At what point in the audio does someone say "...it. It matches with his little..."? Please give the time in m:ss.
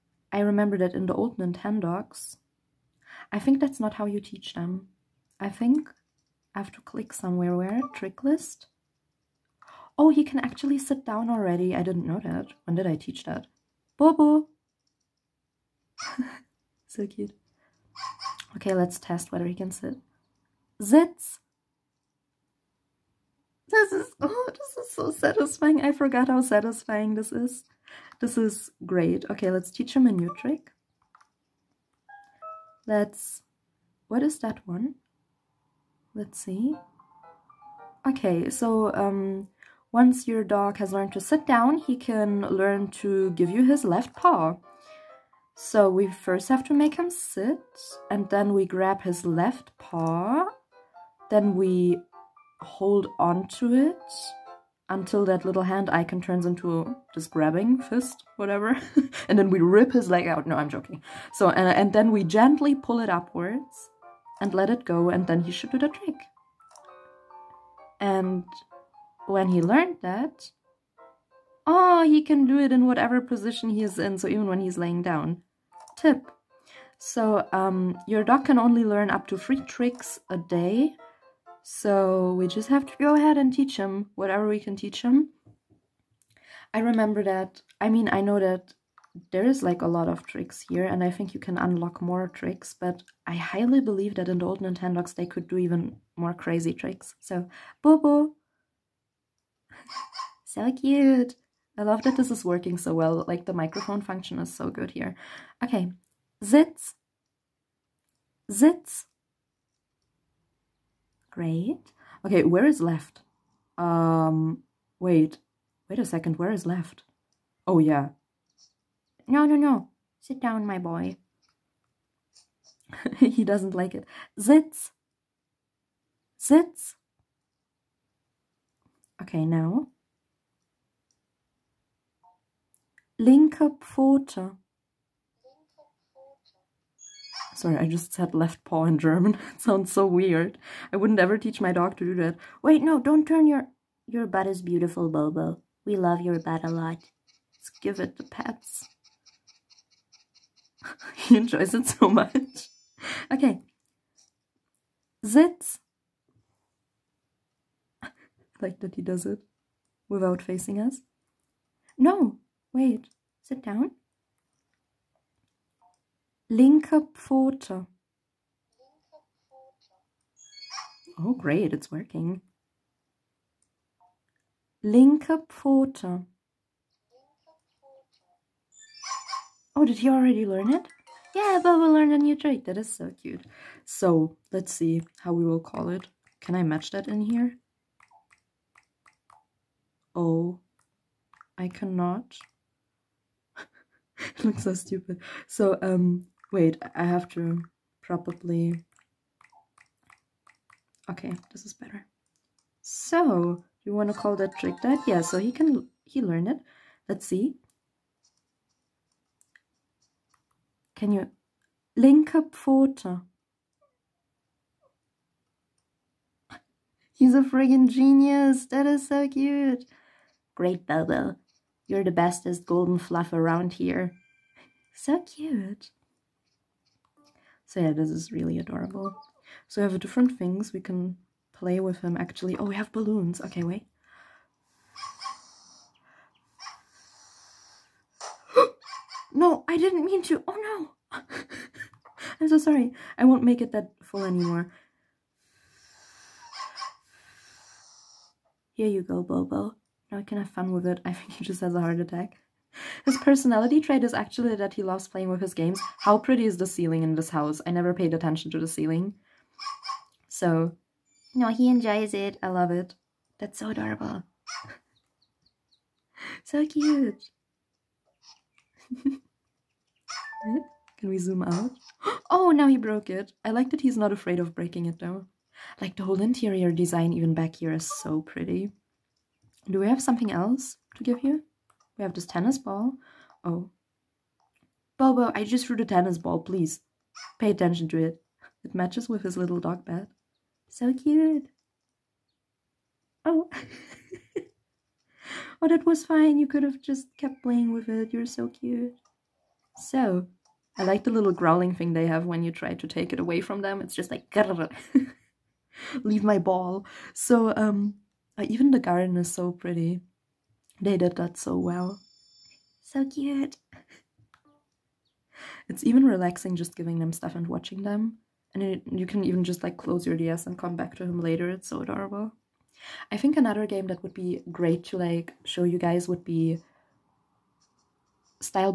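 4:47.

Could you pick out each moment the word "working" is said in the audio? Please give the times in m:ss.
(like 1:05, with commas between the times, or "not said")
1:42, 2:51.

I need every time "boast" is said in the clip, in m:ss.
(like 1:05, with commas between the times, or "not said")
not said.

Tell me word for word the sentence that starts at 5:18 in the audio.
And it, you can even just like close your DS and come back to him later.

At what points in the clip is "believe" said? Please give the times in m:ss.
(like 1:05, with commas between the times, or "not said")
1:33.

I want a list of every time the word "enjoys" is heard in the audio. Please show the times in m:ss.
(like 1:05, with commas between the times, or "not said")
2:31, 4:21.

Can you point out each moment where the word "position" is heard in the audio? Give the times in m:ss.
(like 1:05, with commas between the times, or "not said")
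1:13.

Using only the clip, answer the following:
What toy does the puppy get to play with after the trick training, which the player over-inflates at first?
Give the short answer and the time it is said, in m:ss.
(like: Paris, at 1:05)
Balloons, at 3:52.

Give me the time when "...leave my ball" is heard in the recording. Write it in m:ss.
5:06.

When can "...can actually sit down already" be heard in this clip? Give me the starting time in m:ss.
0:10.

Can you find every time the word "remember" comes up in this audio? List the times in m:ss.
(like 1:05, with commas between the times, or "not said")
0:00, 1:26.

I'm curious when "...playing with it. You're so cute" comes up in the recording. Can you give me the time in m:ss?
4:57.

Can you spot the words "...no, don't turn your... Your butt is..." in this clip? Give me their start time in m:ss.
2:22.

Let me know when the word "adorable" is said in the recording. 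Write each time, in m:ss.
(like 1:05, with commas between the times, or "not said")
3:48, 4:23, 5:21.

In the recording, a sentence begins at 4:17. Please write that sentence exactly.
I never paid attention to the ceiling.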